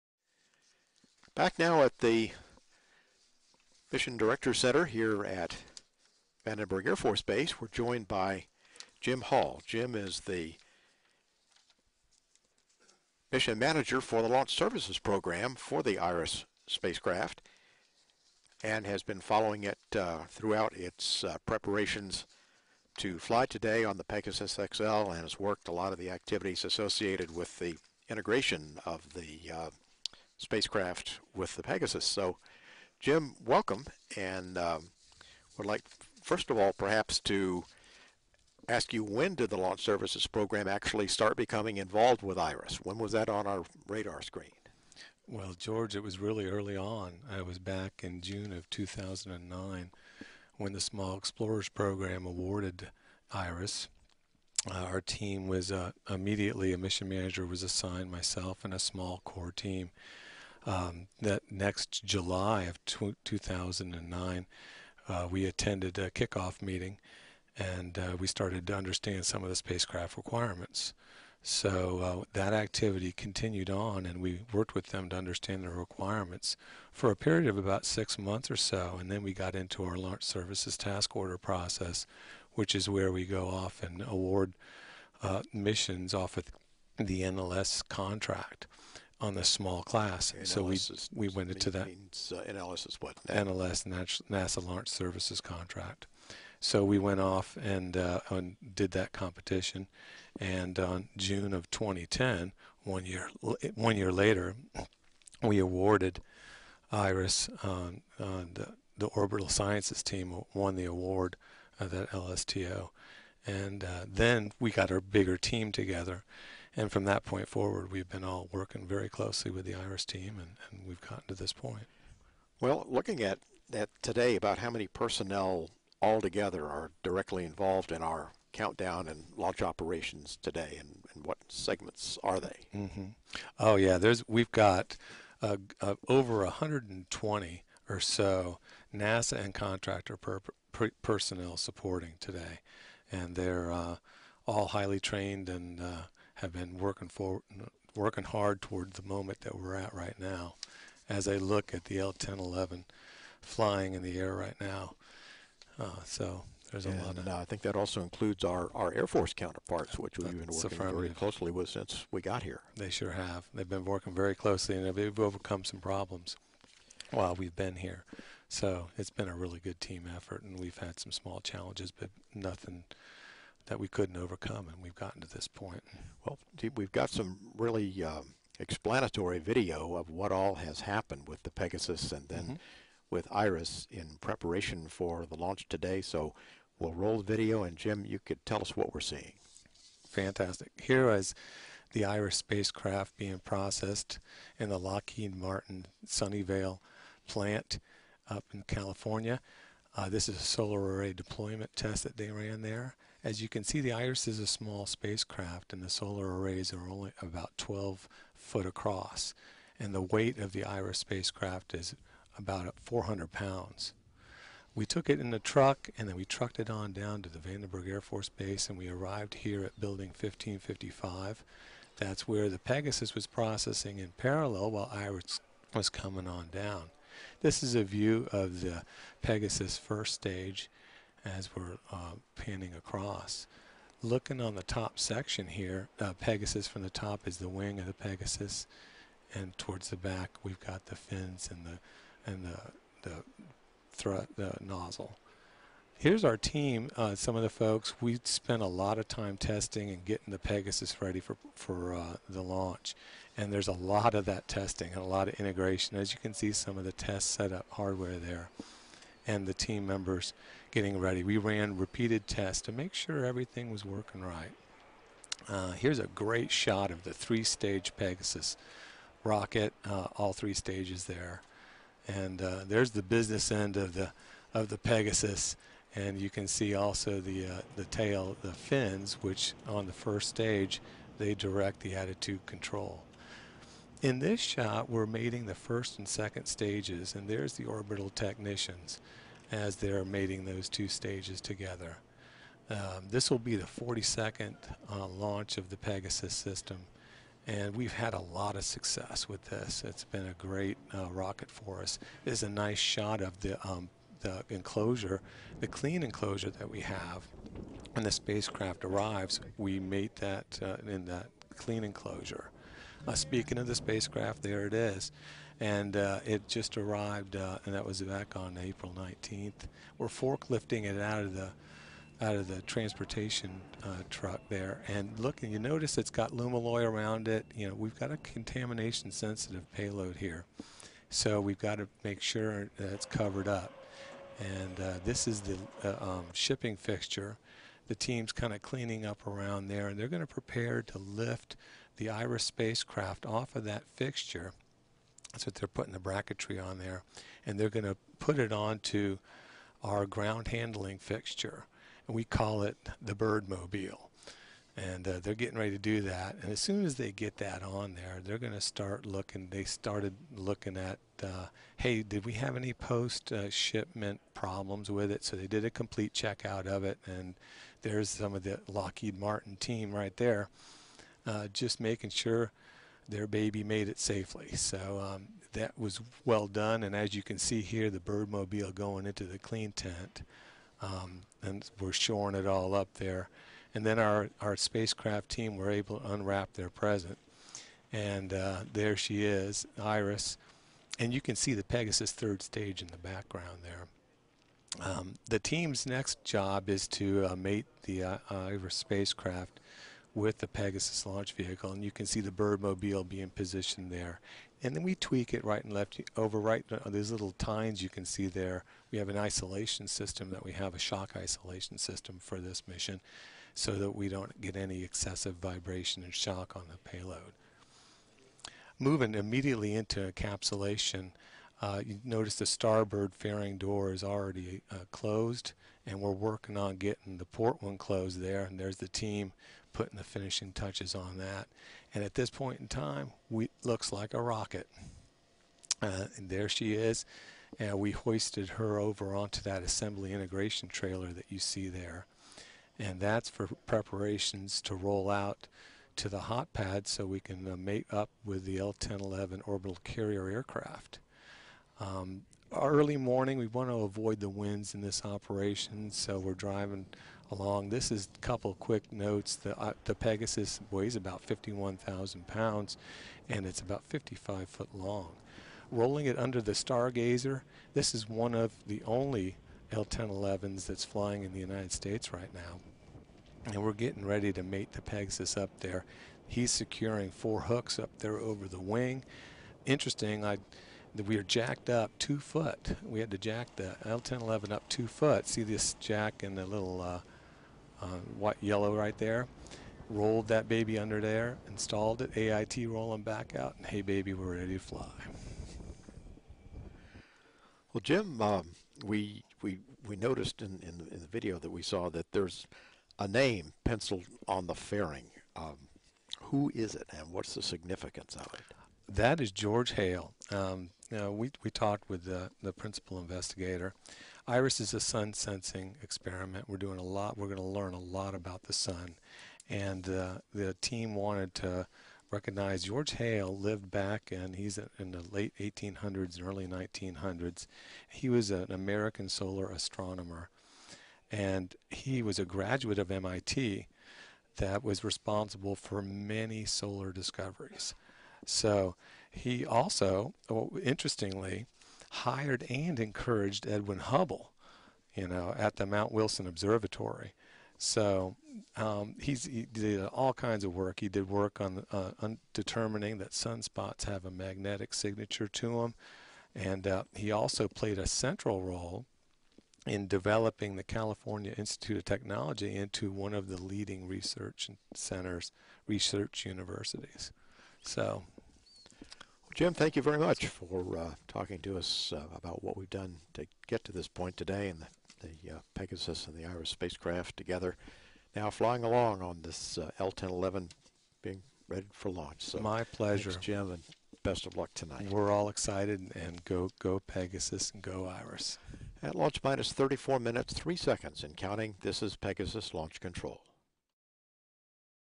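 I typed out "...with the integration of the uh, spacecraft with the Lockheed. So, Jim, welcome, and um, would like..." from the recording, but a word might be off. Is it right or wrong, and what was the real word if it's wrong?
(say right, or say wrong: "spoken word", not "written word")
wrong: "Pegasus", not "Lockheed".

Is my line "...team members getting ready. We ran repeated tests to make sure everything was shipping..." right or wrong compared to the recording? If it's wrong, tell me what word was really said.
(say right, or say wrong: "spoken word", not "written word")
wrong: "working", not "shipping".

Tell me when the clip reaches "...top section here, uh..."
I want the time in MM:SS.
03:54.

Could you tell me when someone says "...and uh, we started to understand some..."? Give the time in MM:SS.
01:07.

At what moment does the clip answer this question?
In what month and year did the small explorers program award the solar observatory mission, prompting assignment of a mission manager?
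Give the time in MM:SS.
00:48.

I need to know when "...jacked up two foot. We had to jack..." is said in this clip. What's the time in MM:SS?
08:01.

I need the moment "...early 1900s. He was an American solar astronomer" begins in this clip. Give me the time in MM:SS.
08:46.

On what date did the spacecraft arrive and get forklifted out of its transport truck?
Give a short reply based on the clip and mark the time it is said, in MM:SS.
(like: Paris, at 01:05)
April 19th, at 05:18.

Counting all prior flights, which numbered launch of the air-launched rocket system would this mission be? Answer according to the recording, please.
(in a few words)
42nd.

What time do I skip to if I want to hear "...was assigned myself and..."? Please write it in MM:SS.
00:57.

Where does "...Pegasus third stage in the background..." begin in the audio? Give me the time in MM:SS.
06:31.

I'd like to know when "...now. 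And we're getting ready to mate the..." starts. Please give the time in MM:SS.
07:52.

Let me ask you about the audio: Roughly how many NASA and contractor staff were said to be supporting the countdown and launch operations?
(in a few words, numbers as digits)
over 120.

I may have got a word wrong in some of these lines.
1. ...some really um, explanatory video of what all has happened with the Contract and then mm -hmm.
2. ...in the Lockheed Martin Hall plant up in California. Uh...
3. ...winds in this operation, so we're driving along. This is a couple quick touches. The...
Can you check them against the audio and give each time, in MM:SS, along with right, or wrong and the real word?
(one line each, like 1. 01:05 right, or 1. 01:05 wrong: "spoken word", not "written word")
1. 02:57 wrong: "Pegasus", not "Contract"
2. 03:14 wrong: "Sunnyvale", not "Hall"
3. 07:34 wrong: "notes", not "touches".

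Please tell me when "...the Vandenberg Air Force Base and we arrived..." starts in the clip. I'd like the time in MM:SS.
03:37.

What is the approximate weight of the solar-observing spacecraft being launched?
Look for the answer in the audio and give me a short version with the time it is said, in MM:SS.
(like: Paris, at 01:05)
400 pounds, at 03:32.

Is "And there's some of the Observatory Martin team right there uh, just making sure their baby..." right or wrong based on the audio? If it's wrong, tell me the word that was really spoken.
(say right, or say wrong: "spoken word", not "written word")
wrong: "Lockheed", not "Observatory".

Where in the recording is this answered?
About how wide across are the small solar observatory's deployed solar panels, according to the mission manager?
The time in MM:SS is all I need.
03:27.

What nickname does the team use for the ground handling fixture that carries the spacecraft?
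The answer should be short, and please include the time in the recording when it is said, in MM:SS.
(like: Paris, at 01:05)
bird mobile, at 05:53.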